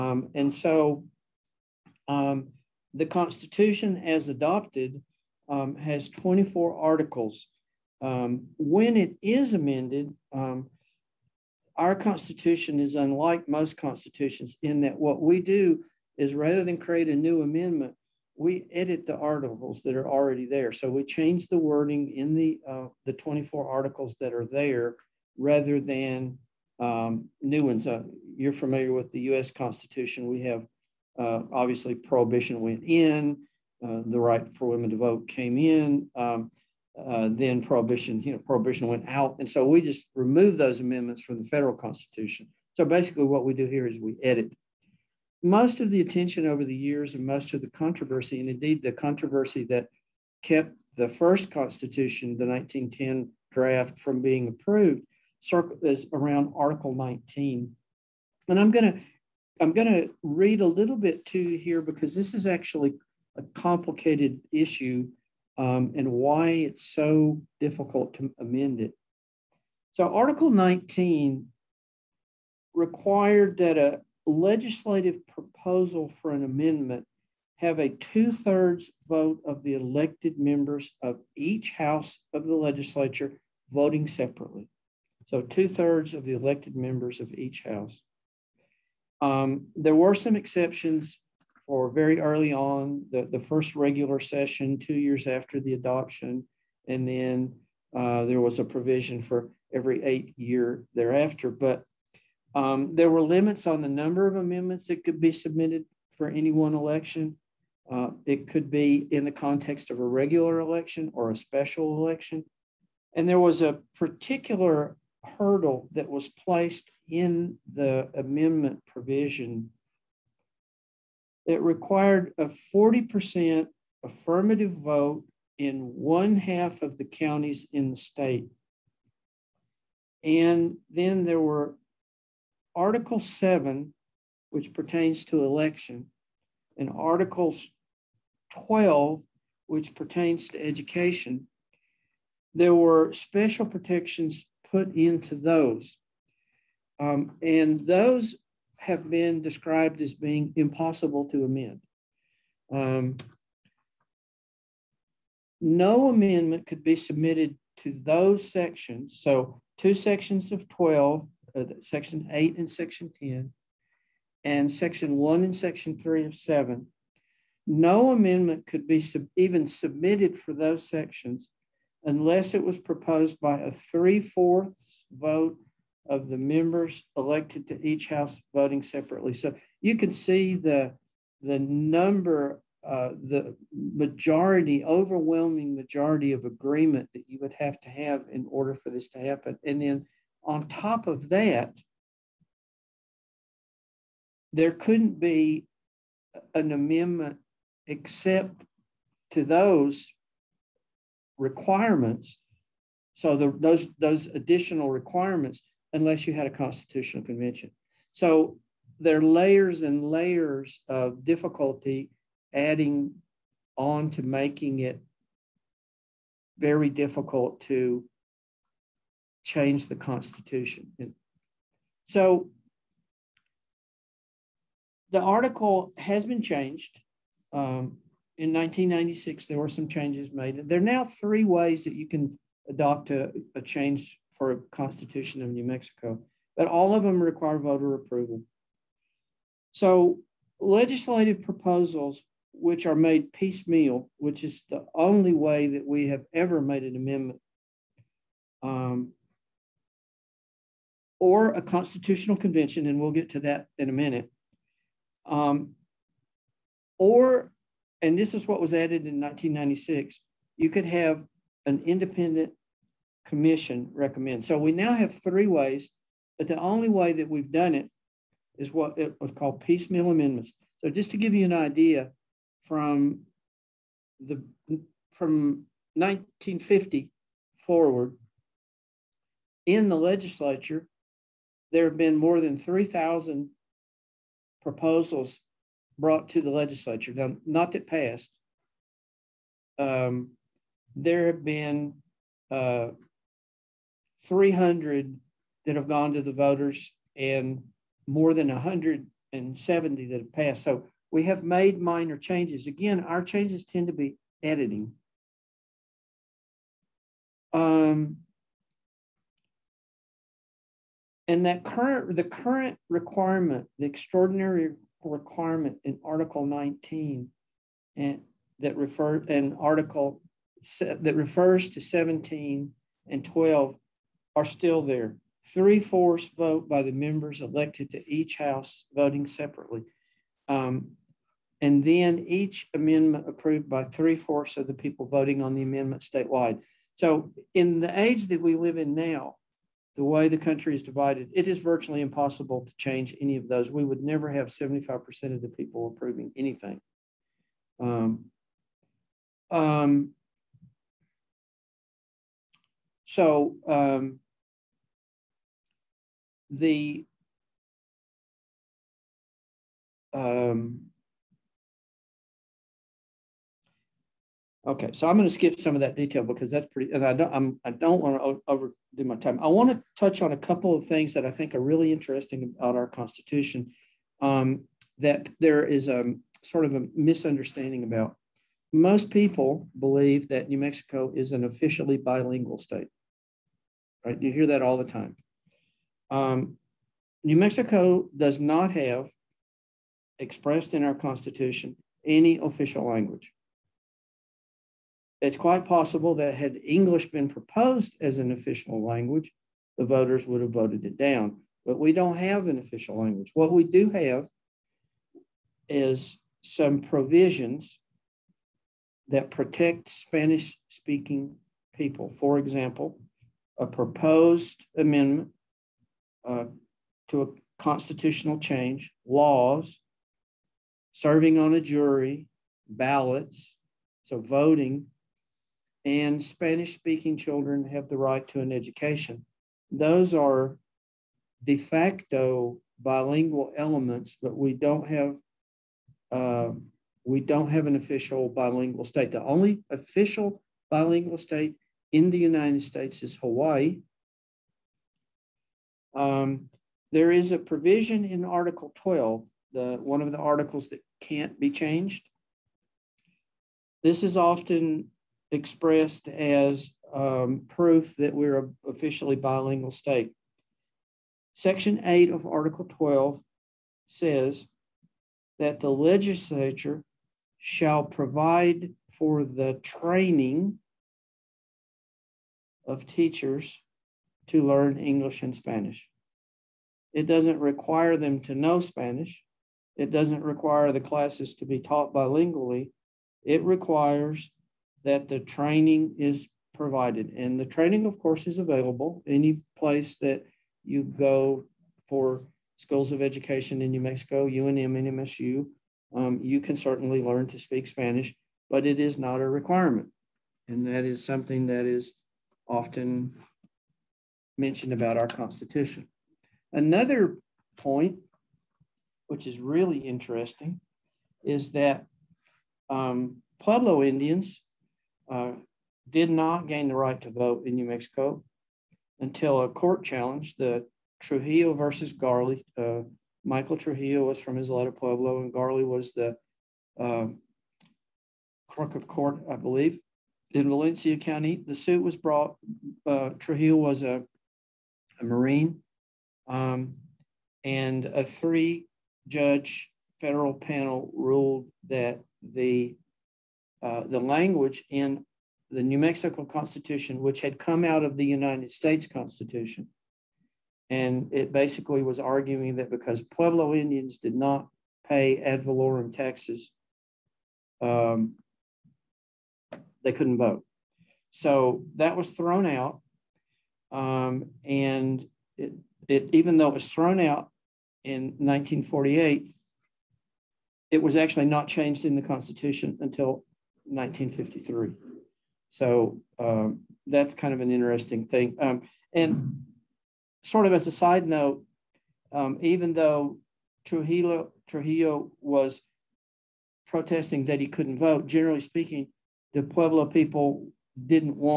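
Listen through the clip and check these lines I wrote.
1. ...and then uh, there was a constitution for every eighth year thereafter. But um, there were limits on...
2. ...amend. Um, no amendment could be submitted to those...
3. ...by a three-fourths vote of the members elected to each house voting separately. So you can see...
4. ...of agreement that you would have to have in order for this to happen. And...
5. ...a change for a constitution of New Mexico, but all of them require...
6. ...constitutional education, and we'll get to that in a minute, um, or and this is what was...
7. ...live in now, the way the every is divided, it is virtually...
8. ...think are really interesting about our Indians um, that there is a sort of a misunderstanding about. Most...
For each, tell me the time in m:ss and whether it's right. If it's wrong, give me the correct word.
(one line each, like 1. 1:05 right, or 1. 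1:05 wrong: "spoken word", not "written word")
1. 1:36 wrong: "provision", not "constitution"
2. 2:31 right
3. 2:53 right
4. 3:06 right
5. 3:53 right
6. 4:11 wrong: "convention", not "education"
7. 5:38 wrong: "country", not "every"
8. 6:11 wrong: "Constitution", not "Indians".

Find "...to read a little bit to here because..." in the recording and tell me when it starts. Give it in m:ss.
0:59.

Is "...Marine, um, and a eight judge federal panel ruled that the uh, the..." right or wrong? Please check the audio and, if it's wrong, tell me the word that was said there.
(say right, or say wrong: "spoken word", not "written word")
wrong: "three", not "eight".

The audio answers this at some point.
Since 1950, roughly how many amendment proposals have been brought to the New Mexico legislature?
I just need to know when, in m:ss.
4:42.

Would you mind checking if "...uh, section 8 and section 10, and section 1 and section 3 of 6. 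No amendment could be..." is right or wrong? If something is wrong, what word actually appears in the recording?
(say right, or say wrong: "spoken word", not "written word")
wrong: "7", not "6".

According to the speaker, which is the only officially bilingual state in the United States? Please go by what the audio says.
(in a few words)
Hawaii.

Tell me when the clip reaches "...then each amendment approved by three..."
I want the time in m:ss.
5:31.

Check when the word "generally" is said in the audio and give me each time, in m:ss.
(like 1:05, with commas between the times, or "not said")
9:48.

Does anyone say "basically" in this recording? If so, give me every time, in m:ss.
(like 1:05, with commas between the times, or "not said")
0:42, 9:11.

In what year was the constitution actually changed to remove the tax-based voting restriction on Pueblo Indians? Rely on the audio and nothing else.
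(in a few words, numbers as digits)
1953.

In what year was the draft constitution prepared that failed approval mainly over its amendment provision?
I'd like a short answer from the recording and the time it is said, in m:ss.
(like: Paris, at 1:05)
1910, at 0:52.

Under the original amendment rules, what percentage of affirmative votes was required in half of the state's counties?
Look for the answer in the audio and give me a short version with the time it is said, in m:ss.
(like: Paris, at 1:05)
40%, at 2:02.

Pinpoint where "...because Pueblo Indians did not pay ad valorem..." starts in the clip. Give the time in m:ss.
9:12.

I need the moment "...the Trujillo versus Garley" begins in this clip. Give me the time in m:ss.
8:40.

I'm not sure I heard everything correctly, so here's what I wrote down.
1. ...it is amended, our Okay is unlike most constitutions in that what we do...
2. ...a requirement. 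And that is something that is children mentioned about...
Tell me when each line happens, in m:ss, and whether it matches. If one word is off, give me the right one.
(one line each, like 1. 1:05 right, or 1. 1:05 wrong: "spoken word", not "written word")
1. 0:08 wrong: "Constitution", not "Okay"
2. 8:19 wrong: "often", not "children".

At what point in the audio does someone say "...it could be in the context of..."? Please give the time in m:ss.
1:48.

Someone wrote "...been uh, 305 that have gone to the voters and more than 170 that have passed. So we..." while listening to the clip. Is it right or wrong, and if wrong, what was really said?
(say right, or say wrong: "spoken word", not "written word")
wrong: "300", not "305".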